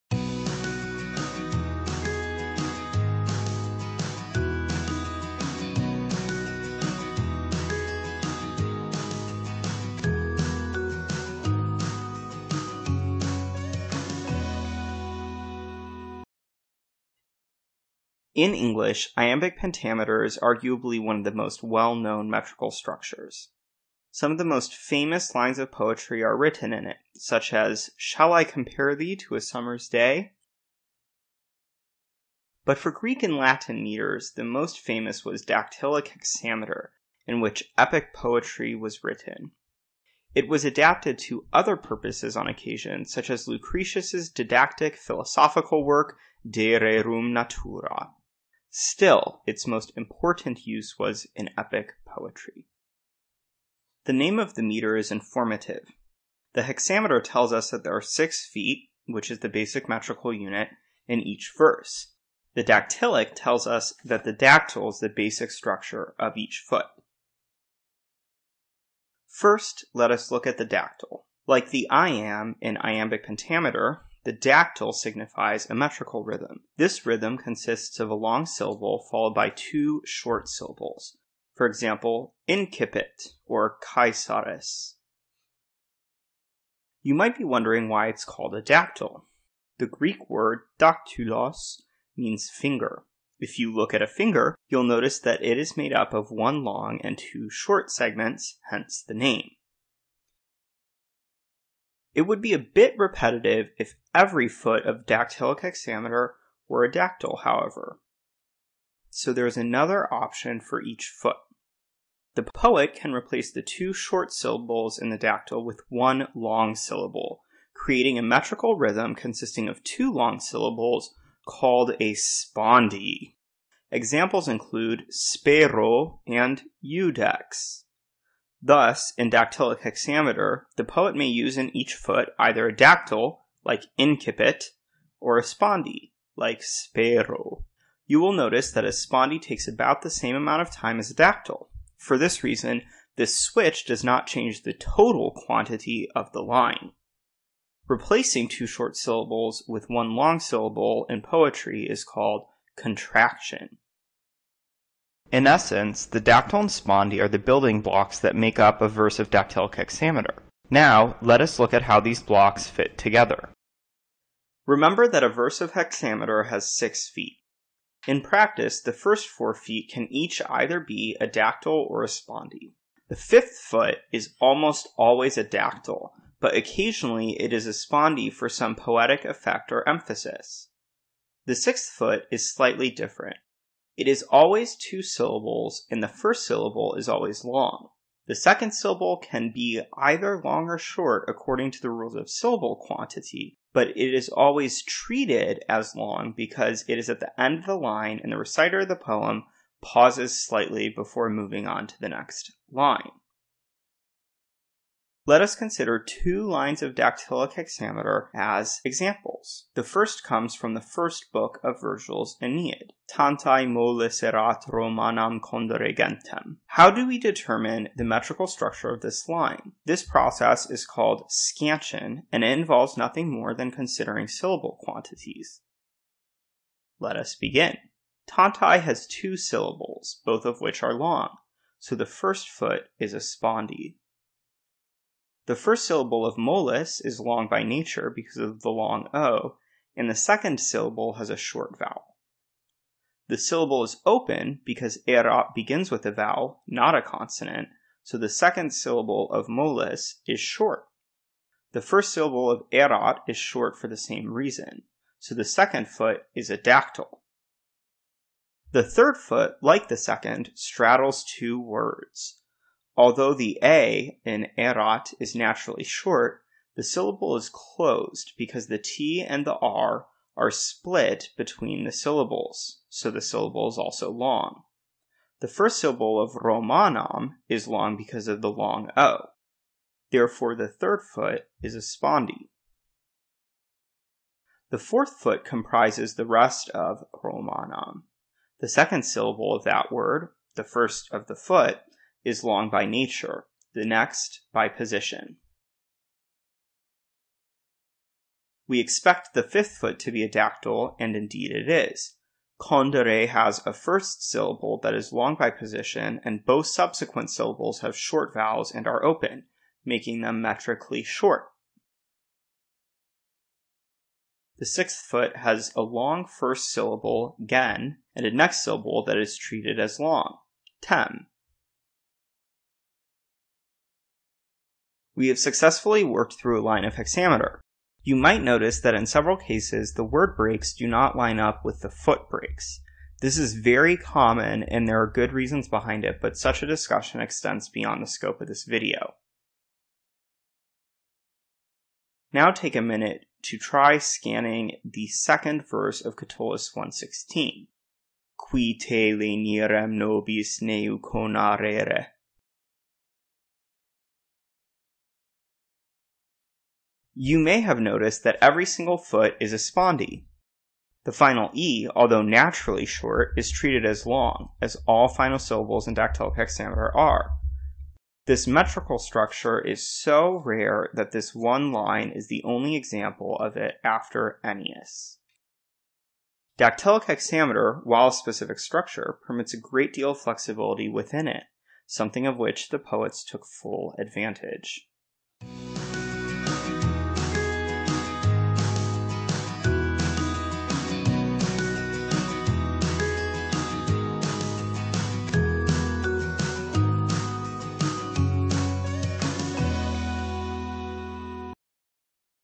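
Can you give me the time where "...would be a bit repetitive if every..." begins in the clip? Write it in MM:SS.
01:42.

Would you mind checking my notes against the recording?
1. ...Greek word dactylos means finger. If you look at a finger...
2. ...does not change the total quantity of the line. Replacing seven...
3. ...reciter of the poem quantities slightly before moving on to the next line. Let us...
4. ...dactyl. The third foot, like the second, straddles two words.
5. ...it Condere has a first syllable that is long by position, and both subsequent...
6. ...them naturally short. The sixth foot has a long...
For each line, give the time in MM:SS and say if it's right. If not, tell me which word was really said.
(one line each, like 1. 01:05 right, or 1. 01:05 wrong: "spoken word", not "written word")
1. 01:29 right
2. 02:23 wrong: "two", not "seven"
3. 03:18 wrong: "pauses", not "quantities"
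4. 04:16 right
5. 05:01 right
6. 05:10 wrong: "metrically", not "naturally".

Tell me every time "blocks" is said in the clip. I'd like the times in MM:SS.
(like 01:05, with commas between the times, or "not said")
02:37, 02:42.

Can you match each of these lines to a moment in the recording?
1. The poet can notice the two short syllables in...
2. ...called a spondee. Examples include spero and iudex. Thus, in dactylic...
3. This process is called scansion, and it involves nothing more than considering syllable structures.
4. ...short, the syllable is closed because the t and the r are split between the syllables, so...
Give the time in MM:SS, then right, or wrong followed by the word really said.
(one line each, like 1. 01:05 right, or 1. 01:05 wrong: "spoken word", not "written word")
1. 01:52 wrong: "replace", not "notice"
2. 02:01 right
3. 03:39 wrong: "quantities", not "structures"
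4. 04:25 right.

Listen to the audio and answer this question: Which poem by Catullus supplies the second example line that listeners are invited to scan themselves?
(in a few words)
Catullus 116.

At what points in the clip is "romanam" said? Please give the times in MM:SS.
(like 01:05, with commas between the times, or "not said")
03:34, 04:36, 04:47.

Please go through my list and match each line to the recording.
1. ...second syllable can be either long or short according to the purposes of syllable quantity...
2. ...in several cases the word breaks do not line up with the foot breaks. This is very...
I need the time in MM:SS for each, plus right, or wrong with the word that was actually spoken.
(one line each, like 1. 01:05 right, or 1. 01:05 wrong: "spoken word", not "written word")
1. 03:08 wrong: "rules", not "purposes"
2. 05:28 right.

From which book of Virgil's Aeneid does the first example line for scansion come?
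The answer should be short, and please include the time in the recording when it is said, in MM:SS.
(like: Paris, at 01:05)
the first book, at 03:30.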